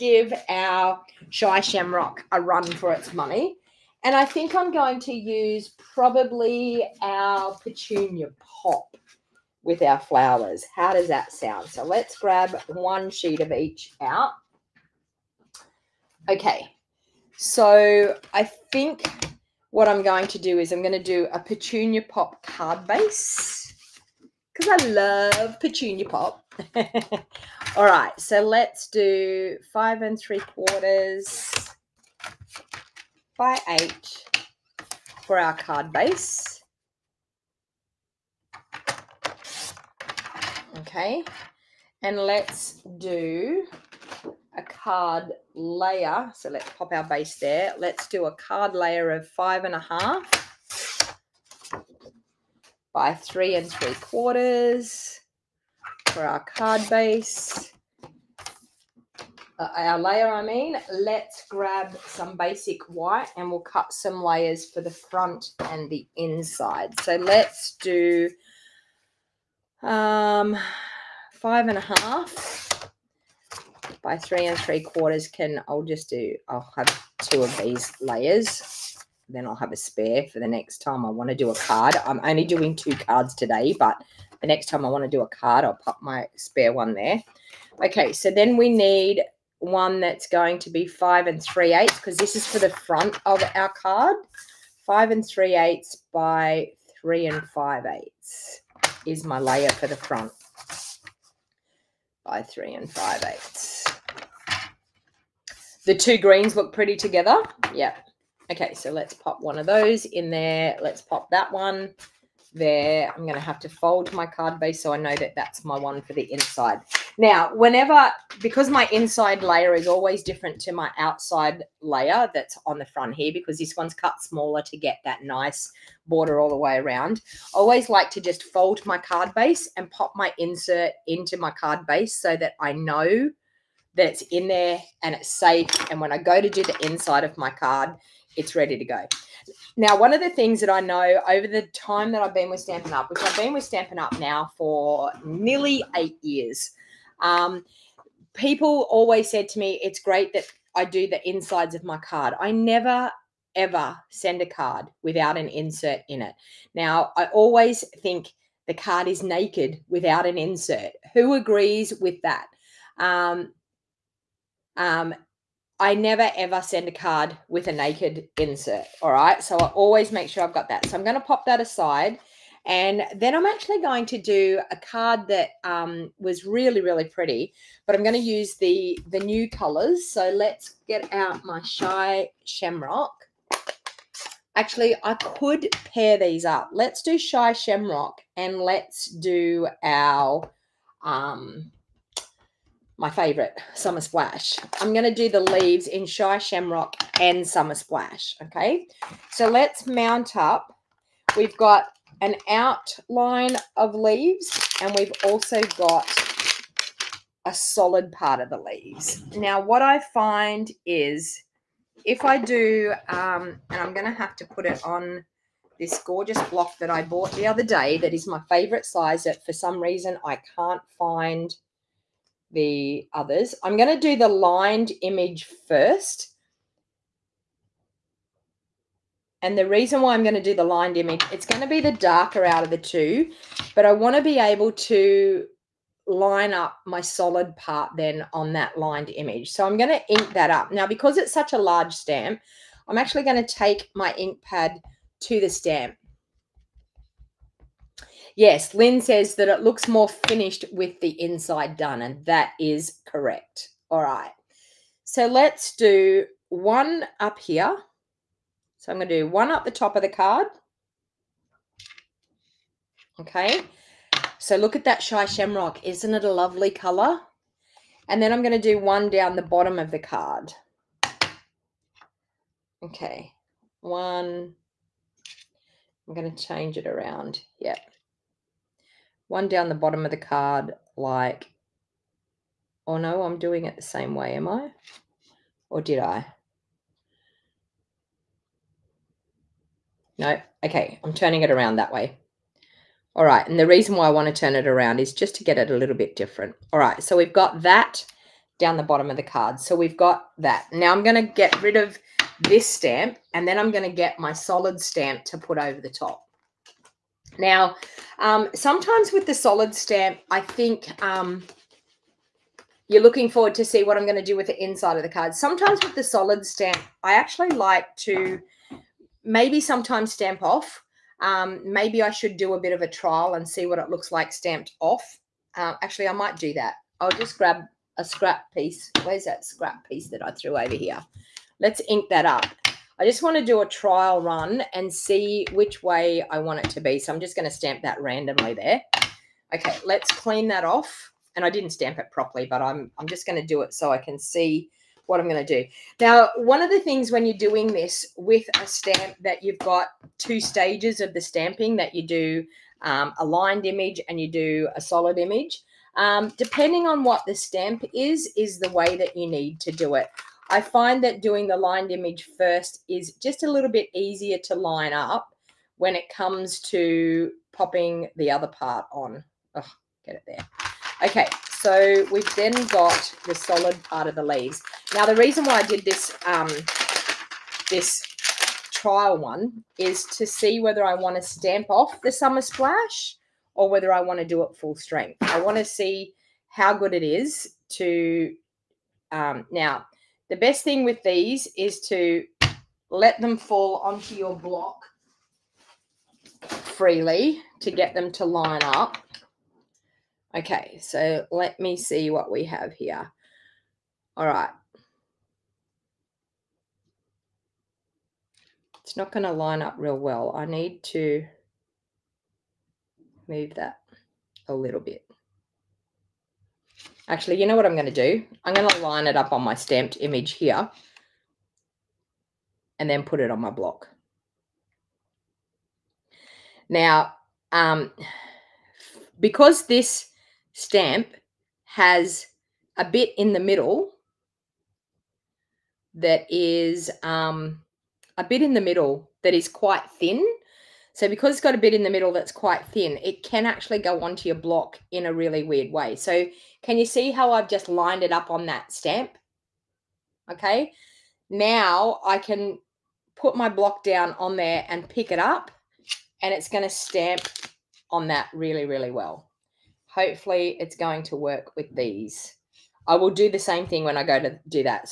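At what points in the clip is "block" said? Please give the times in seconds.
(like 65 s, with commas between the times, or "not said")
216 s, 394 s, 423 s, 444 s, 453 s.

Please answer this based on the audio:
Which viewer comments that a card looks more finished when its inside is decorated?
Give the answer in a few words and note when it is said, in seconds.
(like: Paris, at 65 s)
Lynn, at 248 s.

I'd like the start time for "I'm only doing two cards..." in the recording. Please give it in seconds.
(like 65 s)
82 s.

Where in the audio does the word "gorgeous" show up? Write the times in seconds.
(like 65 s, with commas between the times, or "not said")
216 s.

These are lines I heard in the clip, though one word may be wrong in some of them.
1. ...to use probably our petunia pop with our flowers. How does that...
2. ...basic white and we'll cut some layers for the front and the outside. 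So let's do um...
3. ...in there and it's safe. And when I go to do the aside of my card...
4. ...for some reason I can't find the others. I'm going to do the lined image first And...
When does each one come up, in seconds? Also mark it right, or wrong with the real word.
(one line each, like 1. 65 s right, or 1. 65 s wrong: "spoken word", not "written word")
1. 5 s right
2. 62 s wrong: "inside", not "outside"
3. 134 s wrong: "inside", not "aside"
4. 219 s right.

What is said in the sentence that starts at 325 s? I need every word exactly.
Uh, actually, I might do that.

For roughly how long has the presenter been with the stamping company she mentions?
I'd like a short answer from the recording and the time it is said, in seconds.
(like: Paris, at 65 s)
nearly 8 years, at 145 s.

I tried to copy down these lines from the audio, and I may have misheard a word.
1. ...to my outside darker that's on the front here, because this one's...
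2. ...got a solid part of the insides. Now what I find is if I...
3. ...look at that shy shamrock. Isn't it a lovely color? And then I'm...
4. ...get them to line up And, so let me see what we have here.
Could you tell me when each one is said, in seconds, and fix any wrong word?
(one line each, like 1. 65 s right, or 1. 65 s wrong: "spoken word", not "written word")
1. 120 s wrong: "layer", not "darker"
2. 205 s wrong: "leaves", not "insides"
3. 264 s right
4. 397 s wrong: "Okay", not "And".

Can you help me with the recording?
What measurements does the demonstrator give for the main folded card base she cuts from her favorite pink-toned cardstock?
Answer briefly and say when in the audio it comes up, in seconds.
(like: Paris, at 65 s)
5 3/4 by 8, at 29 s.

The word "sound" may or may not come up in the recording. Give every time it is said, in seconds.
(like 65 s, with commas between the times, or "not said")
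11 s.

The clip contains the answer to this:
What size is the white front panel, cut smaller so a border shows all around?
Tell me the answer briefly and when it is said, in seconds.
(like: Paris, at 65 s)
5 3/8 by 3 5/8, at 94 s.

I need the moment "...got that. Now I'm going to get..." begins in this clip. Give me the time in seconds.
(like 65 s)
299 s.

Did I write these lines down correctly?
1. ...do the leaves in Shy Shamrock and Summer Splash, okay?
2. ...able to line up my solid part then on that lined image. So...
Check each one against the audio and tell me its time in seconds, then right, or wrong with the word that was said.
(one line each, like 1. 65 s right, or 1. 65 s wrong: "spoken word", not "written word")
1. 195 s right
2. 234 s right.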